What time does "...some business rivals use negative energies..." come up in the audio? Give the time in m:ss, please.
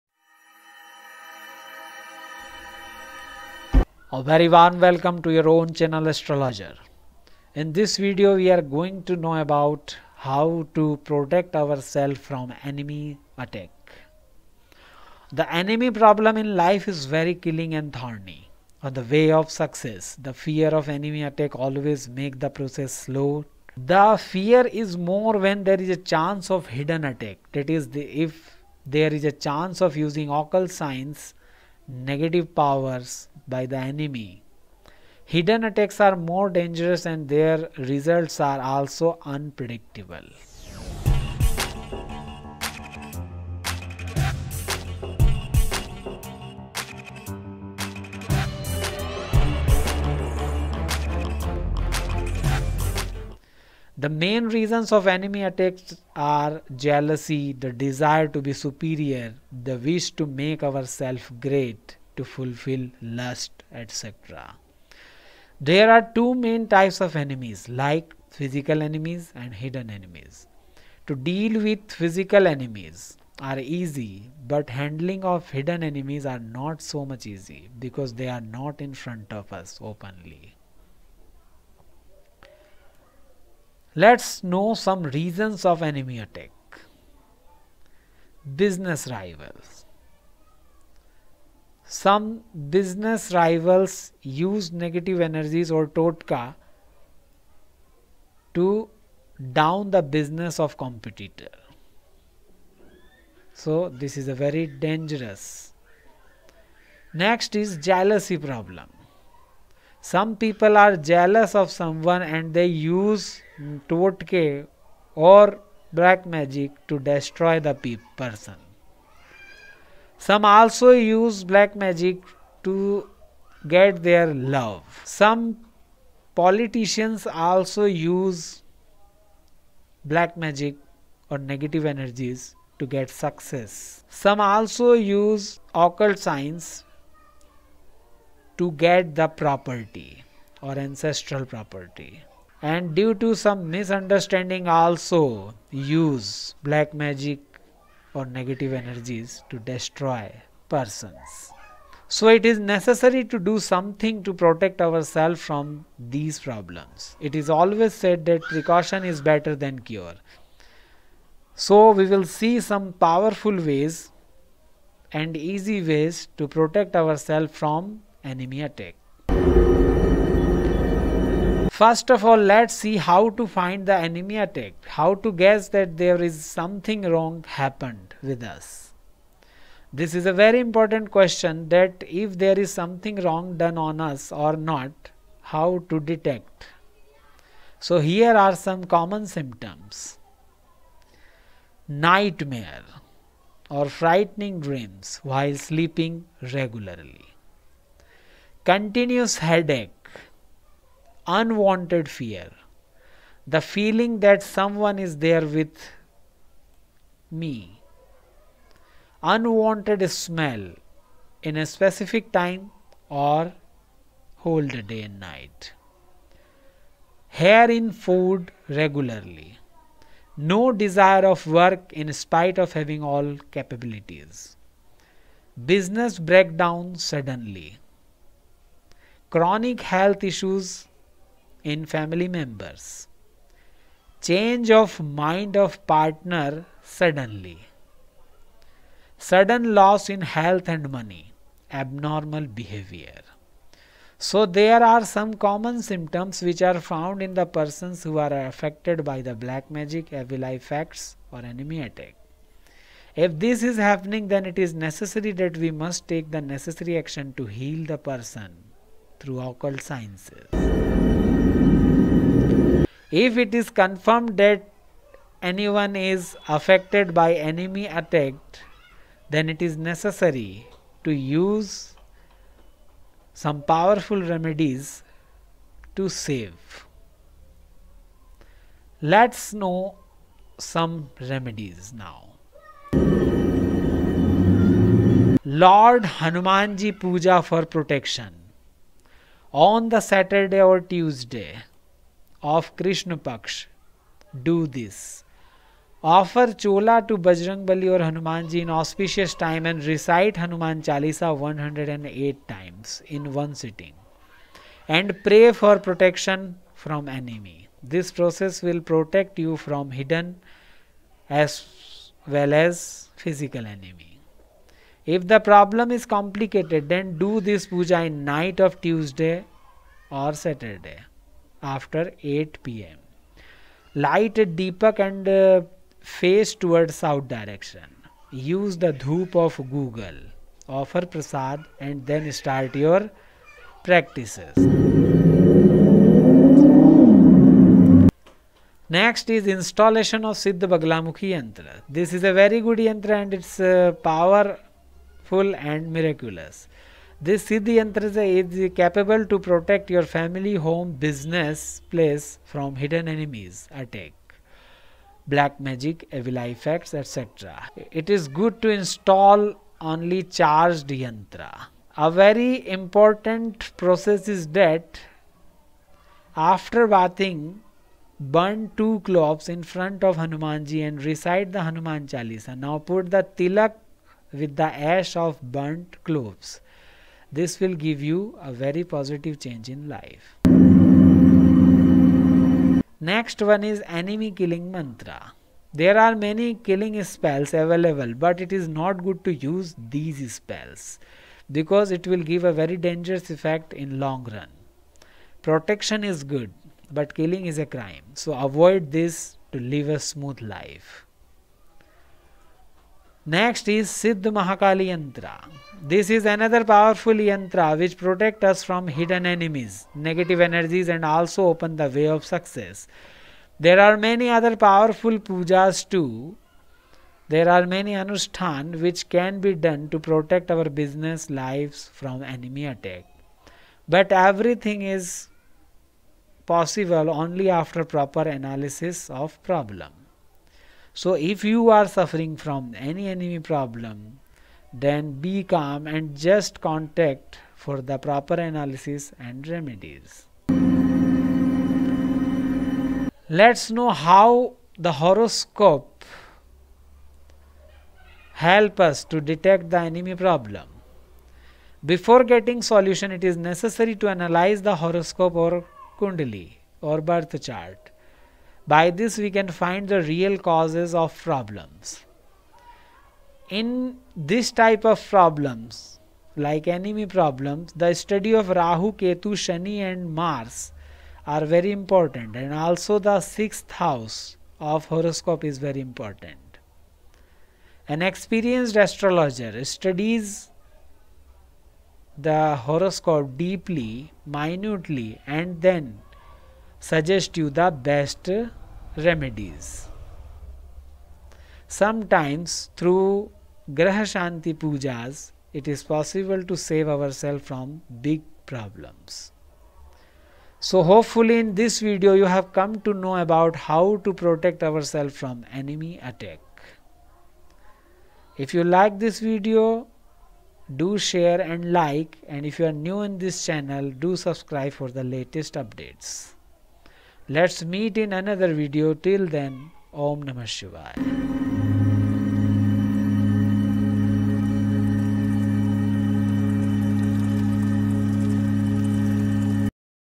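1:31.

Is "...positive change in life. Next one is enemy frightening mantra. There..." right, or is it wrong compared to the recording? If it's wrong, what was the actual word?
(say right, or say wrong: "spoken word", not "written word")
wrong: "killing", not "frightening".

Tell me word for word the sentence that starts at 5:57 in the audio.
It is good to install only charged yantra.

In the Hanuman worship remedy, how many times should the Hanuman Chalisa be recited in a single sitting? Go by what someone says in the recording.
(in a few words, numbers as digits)
108.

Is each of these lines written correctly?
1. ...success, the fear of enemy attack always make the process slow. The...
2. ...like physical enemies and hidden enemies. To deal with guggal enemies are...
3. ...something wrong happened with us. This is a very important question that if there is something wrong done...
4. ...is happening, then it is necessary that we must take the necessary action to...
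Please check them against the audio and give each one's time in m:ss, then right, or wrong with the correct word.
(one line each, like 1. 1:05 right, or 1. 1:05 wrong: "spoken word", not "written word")
1. 0:19 right
2. 1:07 wrong: "physical", not "guggal"
3. 2:56 right
4. 4:13 right.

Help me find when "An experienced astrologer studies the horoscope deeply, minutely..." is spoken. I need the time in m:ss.
7:57.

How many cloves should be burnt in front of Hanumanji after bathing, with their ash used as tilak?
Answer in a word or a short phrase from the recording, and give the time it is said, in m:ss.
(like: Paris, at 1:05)
2, at 6:08.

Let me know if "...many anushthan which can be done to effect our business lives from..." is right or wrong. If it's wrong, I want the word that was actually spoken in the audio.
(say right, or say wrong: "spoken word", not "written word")
wrong: "protect", not "effect".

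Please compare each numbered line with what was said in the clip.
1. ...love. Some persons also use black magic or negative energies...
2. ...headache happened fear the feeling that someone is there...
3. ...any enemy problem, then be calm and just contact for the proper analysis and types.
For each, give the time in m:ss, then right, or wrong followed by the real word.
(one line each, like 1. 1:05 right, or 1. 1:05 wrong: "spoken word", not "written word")
1. 2:04 wrong: "politicians", not "persons"
2. 3:19 wrong: "unwanted", not "happened"
3. 7:12 wrong: "remedies", not "types".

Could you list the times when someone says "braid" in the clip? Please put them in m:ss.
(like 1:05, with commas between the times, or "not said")
not said.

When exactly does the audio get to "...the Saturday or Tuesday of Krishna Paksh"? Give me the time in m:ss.
4:49.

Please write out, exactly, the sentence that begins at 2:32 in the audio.
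So it is necessary to do something to protect ourselves from these problems.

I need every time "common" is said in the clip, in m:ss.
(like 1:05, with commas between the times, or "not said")
3:08, 4:05.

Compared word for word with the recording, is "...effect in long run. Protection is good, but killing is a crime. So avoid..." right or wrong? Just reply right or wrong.
right.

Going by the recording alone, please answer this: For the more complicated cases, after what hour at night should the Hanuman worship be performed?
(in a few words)
8 pm.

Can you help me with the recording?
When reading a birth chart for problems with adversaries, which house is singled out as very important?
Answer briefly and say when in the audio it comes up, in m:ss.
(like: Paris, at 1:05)
Sixth house, at 7:53.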